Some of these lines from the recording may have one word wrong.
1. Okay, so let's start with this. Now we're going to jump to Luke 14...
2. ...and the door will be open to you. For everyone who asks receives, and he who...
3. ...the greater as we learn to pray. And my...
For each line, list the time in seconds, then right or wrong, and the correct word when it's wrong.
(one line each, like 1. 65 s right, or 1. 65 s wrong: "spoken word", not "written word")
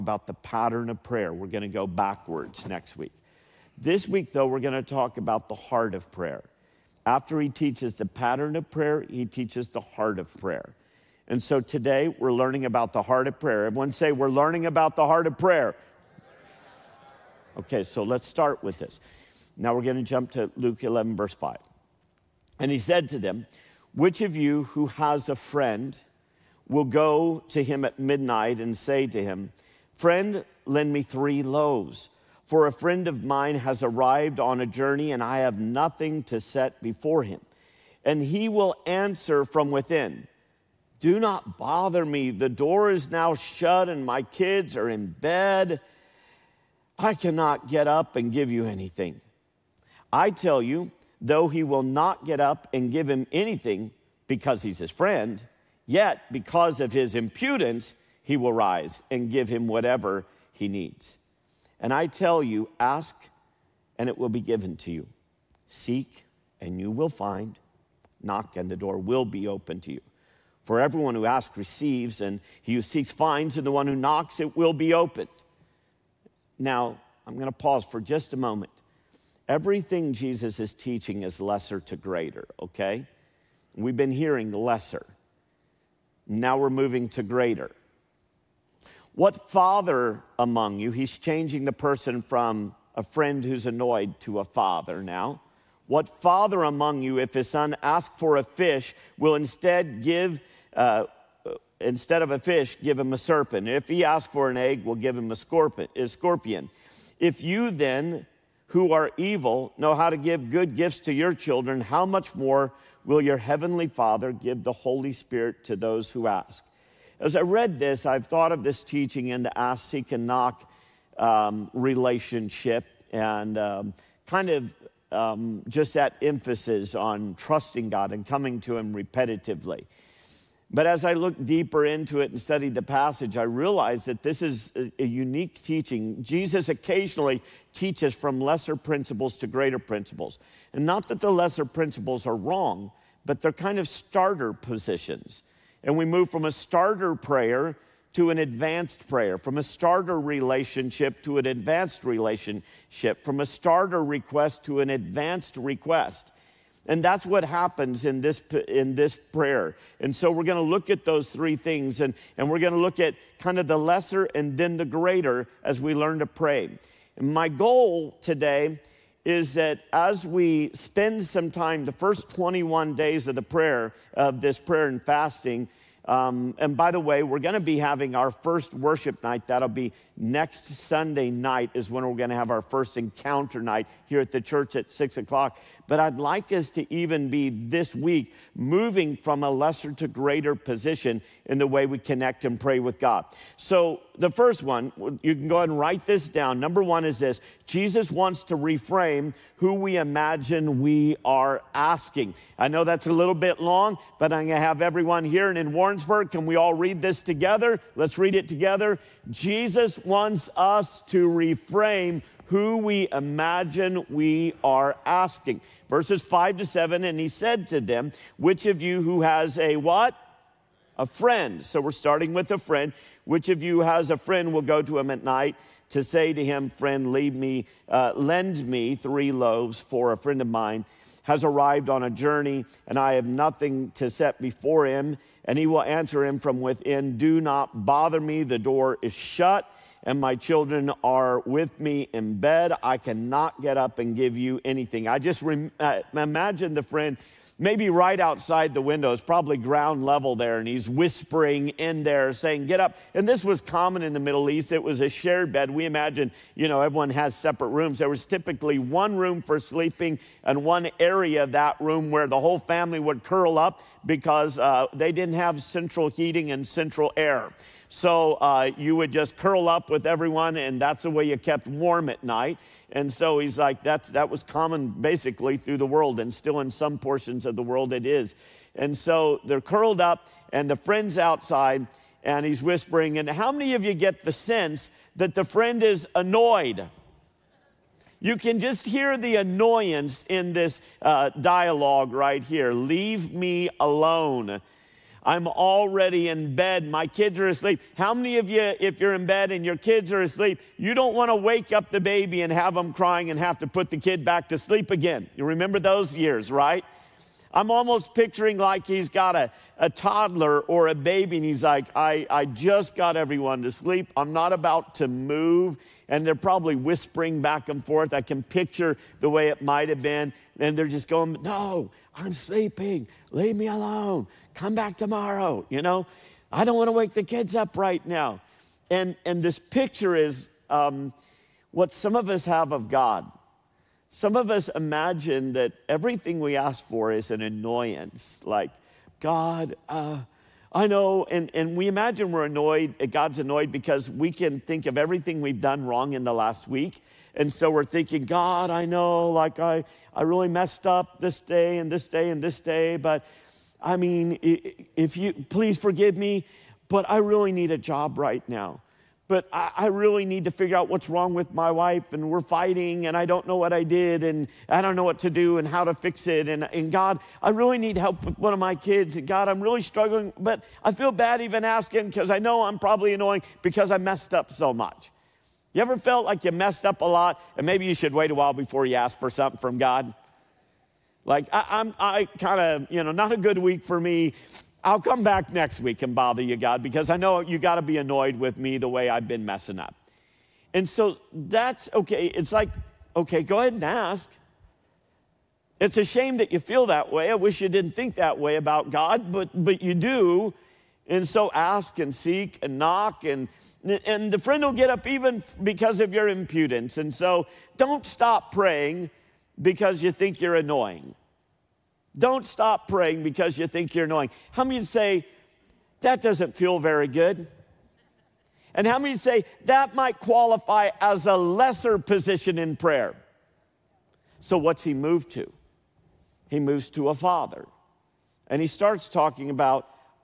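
1. 17 s wrong: "11", not "14"
2. 68 s right
3. 164 s right.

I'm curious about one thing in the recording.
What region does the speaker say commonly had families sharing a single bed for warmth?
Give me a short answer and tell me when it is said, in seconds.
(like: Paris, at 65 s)
Middle East, at 254 s.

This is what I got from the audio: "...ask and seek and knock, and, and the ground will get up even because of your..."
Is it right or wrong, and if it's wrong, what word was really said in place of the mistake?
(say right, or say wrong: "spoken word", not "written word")
wrong: "friend", not "ground".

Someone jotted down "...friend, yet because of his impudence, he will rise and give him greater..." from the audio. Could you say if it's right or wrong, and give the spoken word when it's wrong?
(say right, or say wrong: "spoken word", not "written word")
wrong: "whatever", not "greater".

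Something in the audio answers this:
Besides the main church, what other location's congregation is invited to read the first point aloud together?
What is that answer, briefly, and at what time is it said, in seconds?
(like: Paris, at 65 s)
Warrensburg, at 205 s.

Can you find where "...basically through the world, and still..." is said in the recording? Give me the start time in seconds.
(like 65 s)
274 s.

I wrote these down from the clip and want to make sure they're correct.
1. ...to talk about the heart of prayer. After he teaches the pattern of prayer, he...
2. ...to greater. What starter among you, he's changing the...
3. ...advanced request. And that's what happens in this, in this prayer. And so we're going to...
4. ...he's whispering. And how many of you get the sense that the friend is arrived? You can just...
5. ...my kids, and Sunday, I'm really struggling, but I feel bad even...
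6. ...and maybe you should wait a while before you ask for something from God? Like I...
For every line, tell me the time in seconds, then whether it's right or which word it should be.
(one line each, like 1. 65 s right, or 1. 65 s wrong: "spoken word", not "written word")
1. 4 s right
2. 87 s wrong: "father", not "starter"
3. 154 s right
4. 282 s wrong: "annoyed", not "arrived"
5. 368 s wrong: "God", not "Sunday"
6. 377 s right.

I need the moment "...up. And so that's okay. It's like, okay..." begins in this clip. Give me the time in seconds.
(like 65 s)
389 s.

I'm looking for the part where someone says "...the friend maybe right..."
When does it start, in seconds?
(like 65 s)
246 s.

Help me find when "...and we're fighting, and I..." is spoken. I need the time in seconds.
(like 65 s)
362 s.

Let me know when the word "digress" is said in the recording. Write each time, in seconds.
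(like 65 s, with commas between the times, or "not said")
not said.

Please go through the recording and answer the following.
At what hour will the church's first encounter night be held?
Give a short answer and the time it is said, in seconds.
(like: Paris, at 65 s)
6:00, at 184 s.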